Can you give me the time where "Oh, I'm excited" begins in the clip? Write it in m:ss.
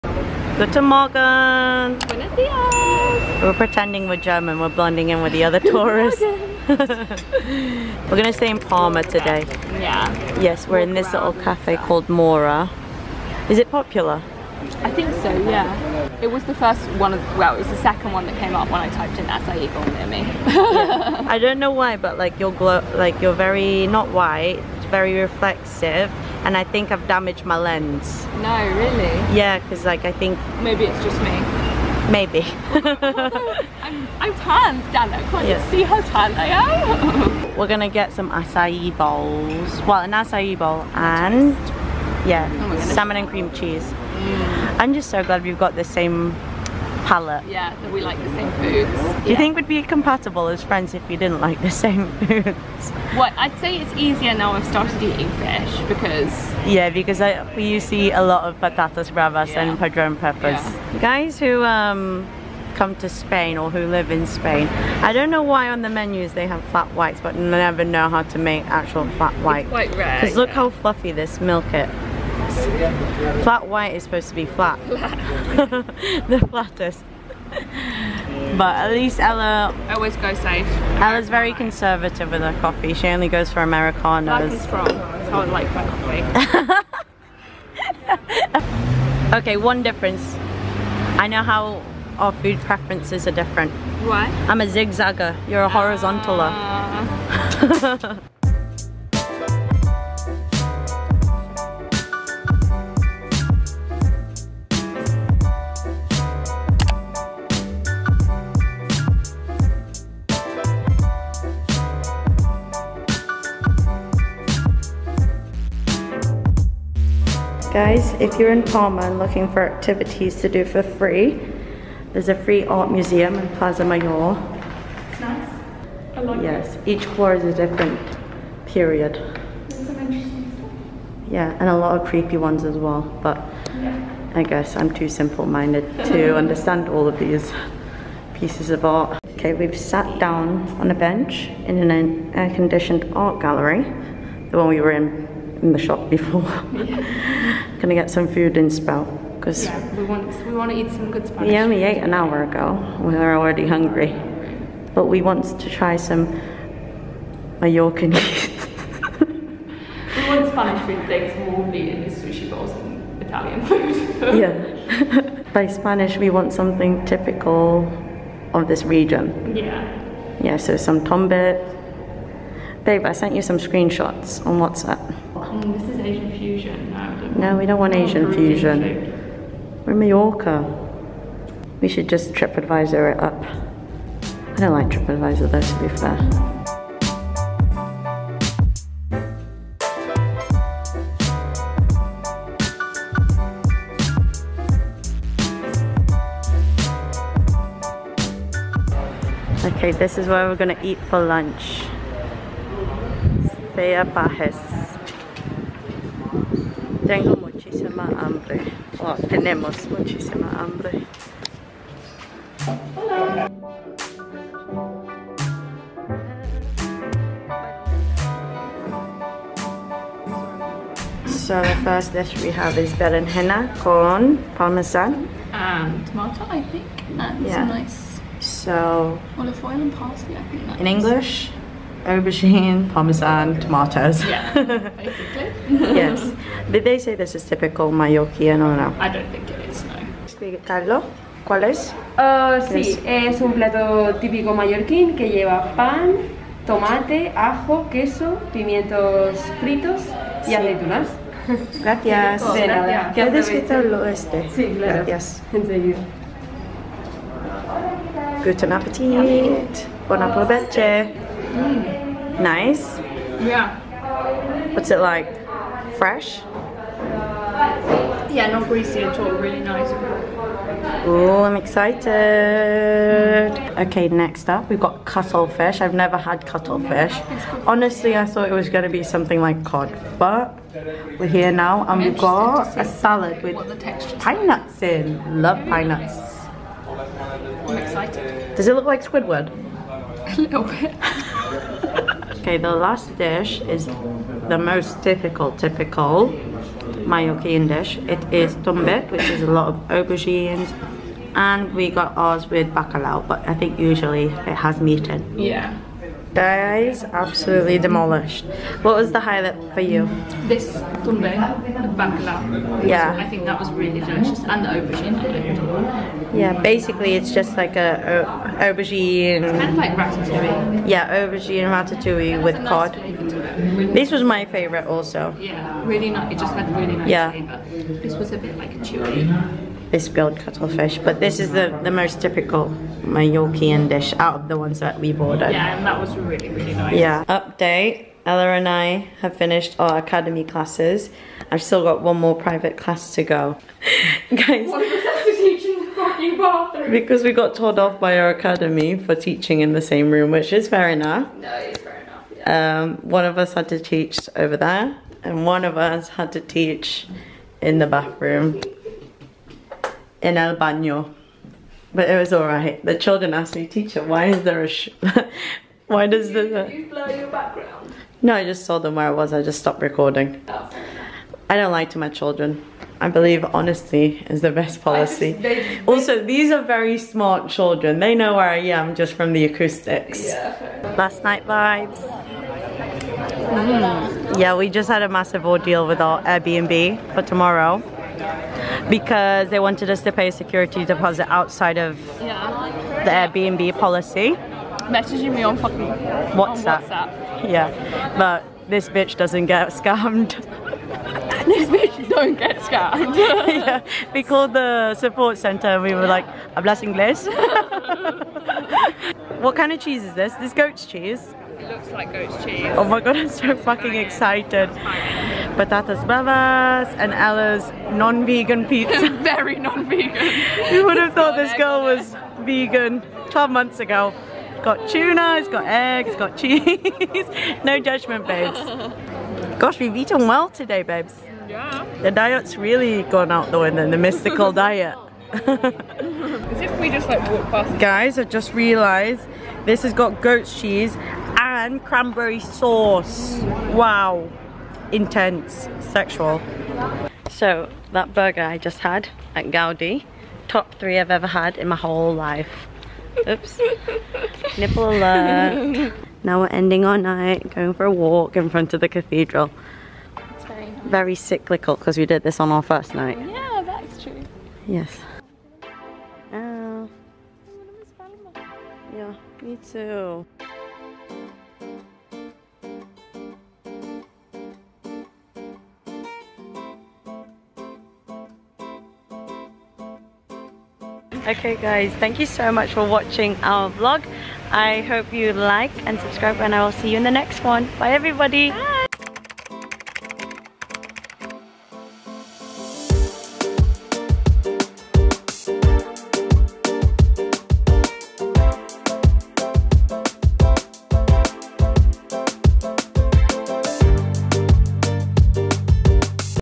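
4:31.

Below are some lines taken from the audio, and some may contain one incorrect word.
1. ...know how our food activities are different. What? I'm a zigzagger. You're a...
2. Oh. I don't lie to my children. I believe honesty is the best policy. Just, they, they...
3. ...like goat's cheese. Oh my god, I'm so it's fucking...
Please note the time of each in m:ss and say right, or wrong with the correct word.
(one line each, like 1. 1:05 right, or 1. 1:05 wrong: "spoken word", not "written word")
1. 1:31 wrong: "preferences", not "activities"
2. 6:10 right
3. 6:51 right.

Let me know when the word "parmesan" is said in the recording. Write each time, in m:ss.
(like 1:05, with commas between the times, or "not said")
3:44, 3:52.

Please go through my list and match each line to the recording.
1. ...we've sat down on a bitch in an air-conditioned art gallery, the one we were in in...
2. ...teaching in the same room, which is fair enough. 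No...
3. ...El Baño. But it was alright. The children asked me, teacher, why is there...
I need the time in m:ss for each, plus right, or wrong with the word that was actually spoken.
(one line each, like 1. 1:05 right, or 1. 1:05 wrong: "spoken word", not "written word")
1. 2:19 wrong: "bench", not "bitch"
2. 5:49 right
3. 6:00 right.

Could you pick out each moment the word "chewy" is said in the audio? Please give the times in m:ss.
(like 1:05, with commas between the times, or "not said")
5:28.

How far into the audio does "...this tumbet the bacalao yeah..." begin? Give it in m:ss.
5:10.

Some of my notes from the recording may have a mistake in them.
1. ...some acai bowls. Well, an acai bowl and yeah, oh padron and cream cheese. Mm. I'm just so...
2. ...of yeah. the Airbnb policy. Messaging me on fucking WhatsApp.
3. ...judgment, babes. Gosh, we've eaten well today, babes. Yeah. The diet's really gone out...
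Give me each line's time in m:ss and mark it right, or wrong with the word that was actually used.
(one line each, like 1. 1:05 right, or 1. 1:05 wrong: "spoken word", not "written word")
1. 0:38 wrong: "salmon", not "padron"
2. 6:31 right
3. 7:07 right.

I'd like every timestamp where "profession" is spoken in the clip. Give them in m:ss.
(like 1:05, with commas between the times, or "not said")
not said.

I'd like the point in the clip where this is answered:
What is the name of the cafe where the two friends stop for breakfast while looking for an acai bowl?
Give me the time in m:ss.
0:12.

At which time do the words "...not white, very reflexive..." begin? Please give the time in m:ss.
0:23.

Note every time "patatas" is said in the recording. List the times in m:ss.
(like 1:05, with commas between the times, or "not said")
0:58, 6:55.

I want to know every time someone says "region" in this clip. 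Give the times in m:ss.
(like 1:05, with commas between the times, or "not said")
2:48.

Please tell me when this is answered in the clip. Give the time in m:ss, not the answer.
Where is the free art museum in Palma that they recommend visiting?
2:03.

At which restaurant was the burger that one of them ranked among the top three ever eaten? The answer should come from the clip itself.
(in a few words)
Gaudi.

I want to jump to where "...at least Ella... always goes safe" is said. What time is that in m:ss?
1:18.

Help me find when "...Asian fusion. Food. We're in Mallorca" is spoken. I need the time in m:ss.
2:58.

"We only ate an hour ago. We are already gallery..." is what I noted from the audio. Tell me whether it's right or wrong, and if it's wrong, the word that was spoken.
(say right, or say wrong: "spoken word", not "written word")
wrong: "hungry", not "gallery".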